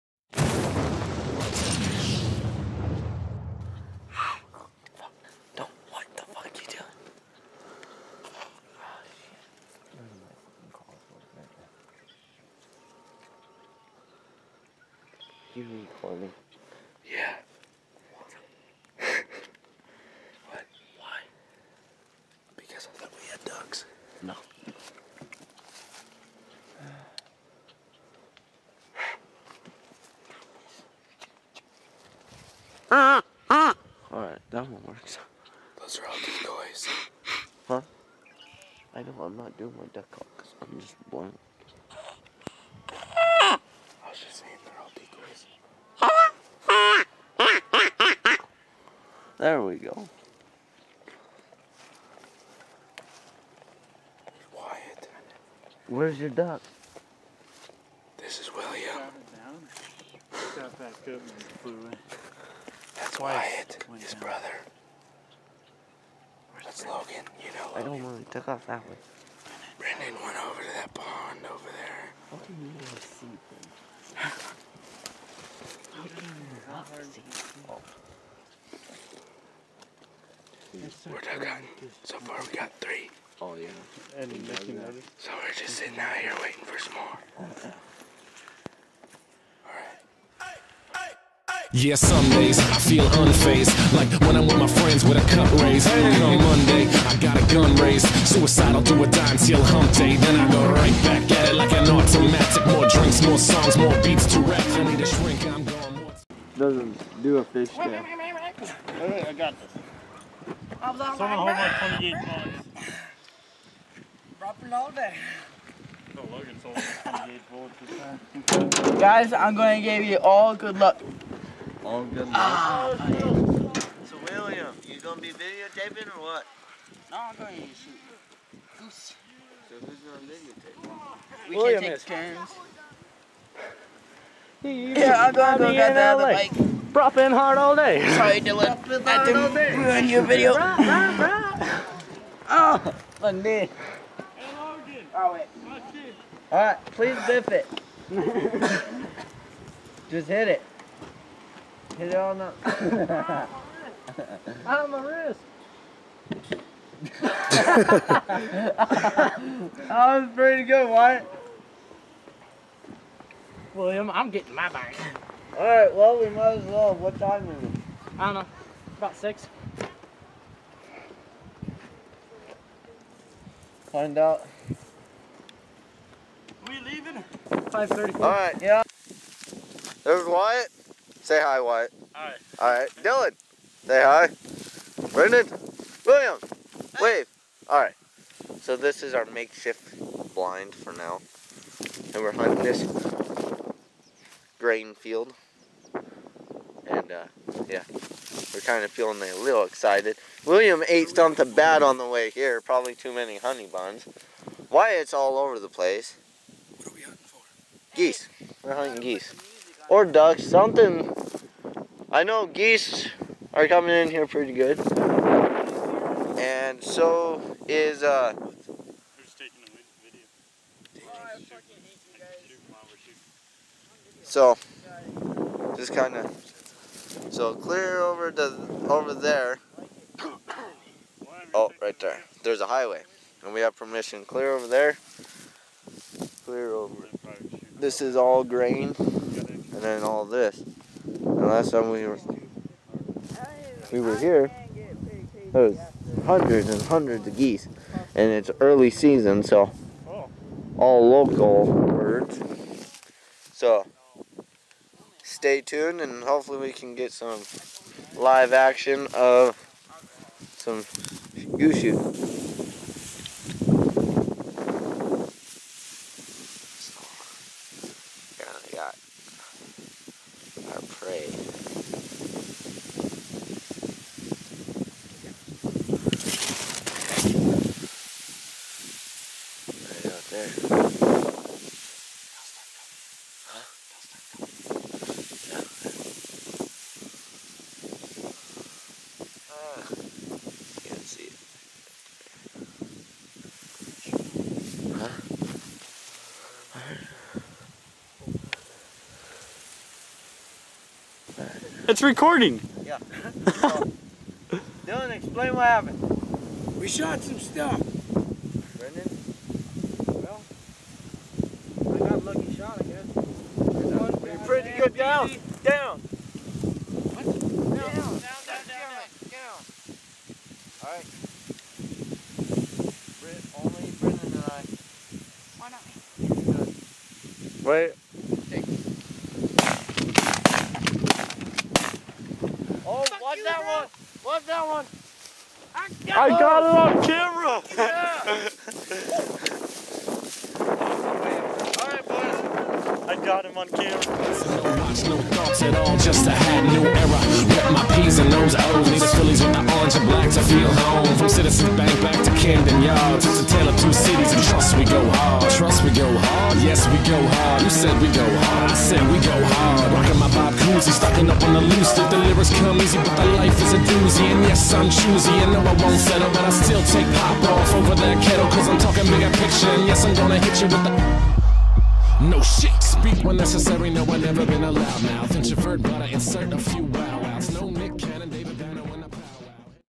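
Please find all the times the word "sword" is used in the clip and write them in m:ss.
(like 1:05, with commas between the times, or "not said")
not said.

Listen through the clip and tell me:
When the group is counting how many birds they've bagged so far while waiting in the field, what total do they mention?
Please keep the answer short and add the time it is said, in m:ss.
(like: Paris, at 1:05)
3, at 1:22.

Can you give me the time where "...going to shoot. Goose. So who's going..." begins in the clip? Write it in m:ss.
2:07.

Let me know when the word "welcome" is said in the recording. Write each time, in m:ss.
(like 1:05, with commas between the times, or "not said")
not said.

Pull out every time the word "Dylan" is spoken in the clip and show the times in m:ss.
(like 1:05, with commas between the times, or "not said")
2:18, 3:03, 5:04.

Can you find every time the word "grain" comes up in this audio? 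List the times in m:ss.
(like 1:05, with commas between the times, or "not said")
3:14, 3:58.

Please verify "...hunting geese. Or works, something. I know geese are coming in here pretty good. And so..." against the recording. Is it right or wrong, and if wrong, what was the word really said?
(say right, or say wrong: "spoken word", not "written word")
wrong: "ducks", not "works".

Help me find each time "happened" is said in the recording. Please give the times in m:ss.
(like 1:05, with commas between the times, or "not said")
5:05.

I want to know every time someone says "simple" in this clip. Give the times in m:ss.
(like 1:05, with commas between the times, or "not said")
not said.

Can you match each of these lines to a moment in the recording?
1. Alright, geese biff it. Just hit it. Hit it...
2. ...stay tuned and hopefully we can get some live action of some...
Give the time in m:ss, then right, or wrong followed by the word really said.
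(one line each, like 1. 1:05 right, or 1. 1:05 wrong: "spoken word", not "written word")
1. 2:26 wrong: "please", not "geese"
2. 4:15 right.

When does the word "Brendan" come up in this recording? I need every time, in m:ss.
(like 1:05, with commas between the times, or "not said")
1:09, 3:05, 5:08, 5:23.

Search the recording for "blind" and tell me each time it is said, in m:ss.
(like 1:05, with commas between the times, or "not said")
0:41, 3:10.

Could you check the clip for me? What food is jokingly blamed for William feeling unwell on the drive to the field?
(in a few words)
Honey buns.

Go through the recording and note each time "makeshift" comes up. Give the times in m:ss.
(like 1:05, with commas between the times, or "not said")
3:09.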